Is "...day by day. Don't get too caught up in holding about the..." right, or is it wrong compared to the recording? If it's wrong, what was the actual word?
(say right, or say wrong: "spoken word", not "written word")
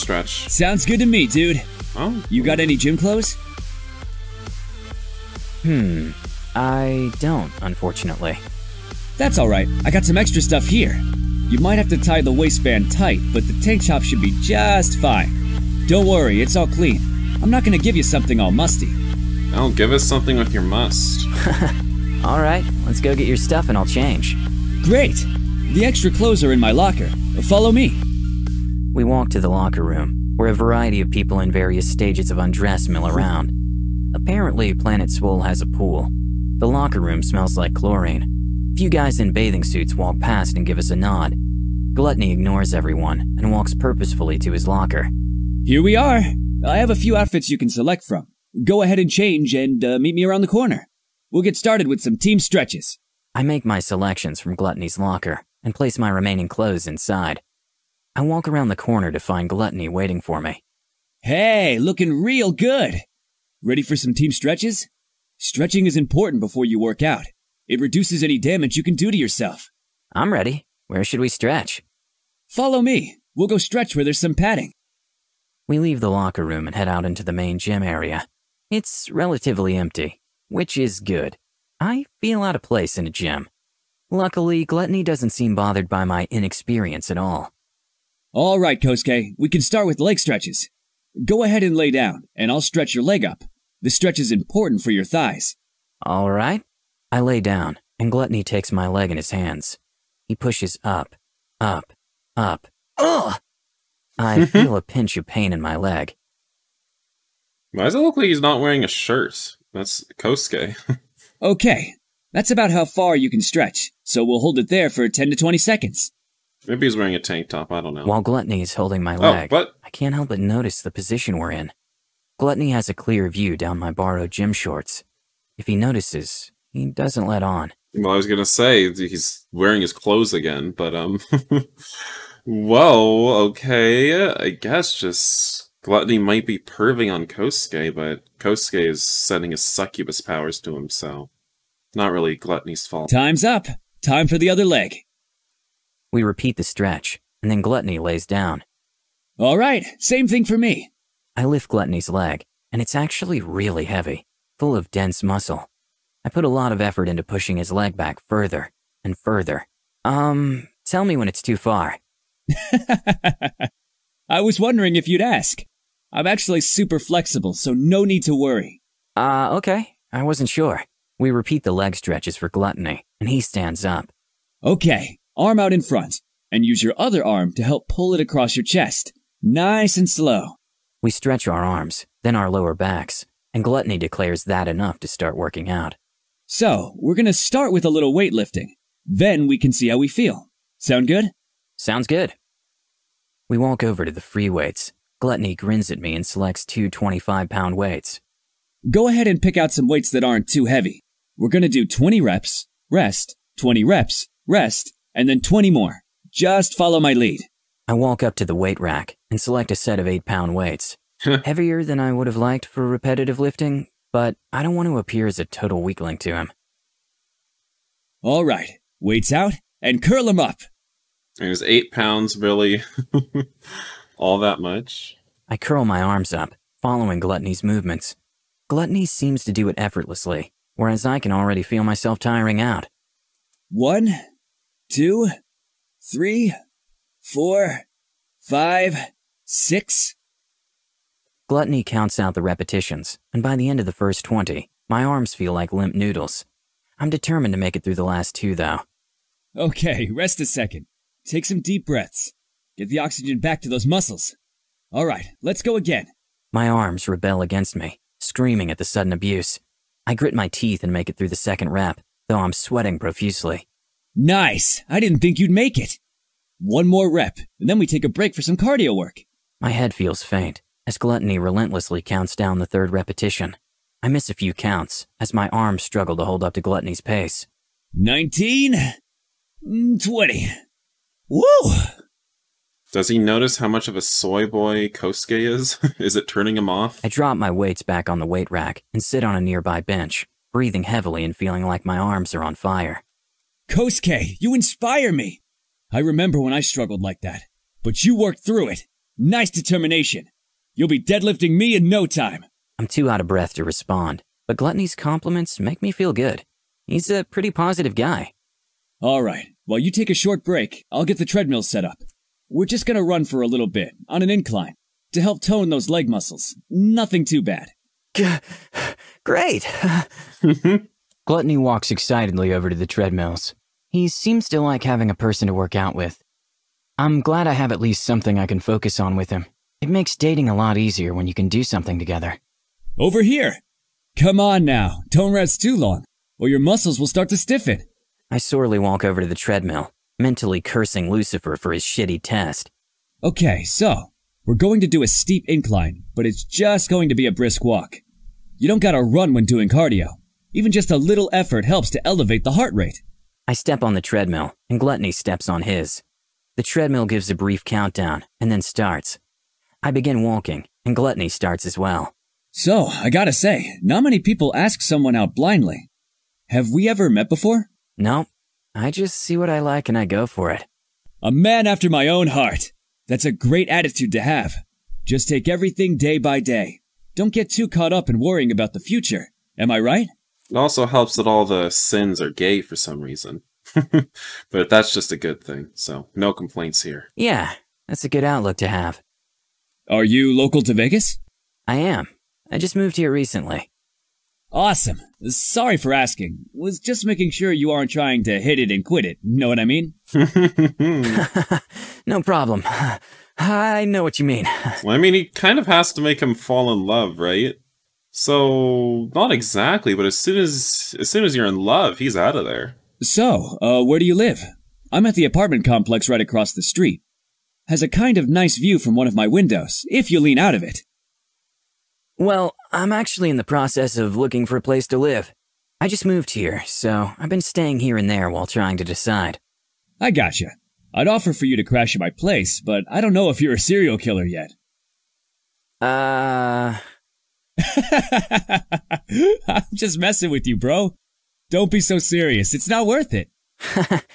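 wrong: "worrying", not "holding".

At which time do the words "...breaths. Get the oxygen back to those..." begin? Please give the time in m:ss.
4:11.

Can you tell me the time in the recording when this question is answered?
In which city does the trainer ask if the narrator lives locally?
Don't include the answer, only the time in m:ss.
6:30.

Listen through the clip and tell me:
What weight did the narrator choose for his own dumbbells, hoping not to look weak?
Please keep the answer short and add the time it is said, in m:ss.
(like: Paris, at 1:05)
8 pounds, at 3:30.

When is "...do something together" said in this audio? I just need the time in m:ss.
5:31.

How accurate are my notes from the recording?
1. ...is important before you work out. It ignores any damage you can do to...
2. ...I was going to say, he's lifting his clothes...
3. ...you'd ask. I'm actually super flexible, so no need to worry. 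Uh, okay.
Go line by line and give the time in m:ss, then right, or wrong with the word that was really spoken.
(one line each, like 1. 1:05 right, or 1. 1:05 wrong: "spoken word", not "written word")
1. 1:05 wrong: "reduces", not "ignores"
2. 2:08 wrong: "wearing", not "lifting"
3. 2:45 right.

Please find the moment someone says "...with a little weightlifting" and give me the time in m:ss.
3:07.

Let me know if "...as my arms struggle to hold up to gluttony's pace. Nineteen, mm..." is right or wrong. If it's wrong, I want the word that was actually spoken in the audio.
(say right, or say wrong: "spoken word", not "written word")
right.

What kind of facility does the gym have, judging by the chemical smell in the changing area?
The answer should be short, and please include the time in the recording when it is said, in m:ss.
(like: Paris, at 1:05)
A pool, at 0:35.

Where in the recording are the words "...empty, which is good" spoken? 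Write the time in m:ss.
1:19.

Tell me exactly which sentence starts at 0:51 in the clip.
We'll get started with some team stretches.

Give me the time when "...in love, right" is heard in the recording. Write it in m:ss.
6:46.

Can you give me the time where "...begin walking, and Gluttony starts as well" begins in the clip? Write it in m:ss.
5:59.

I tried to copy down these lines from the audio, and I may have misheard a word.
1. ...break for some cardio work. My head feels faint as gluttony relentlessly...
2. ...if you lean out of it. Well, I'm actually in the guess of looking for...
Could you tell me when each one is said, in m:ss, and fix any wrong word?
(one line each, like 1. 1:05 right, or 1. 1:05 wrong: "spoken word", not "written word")
1. 4:28 right
2. 6:59 wrong: "process", not "guess".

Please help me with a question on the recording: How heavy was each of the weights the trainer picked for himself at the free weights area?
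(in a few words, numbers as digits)
25 pounds.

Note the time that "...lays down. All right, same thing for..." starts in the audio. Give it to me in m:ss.
2:27.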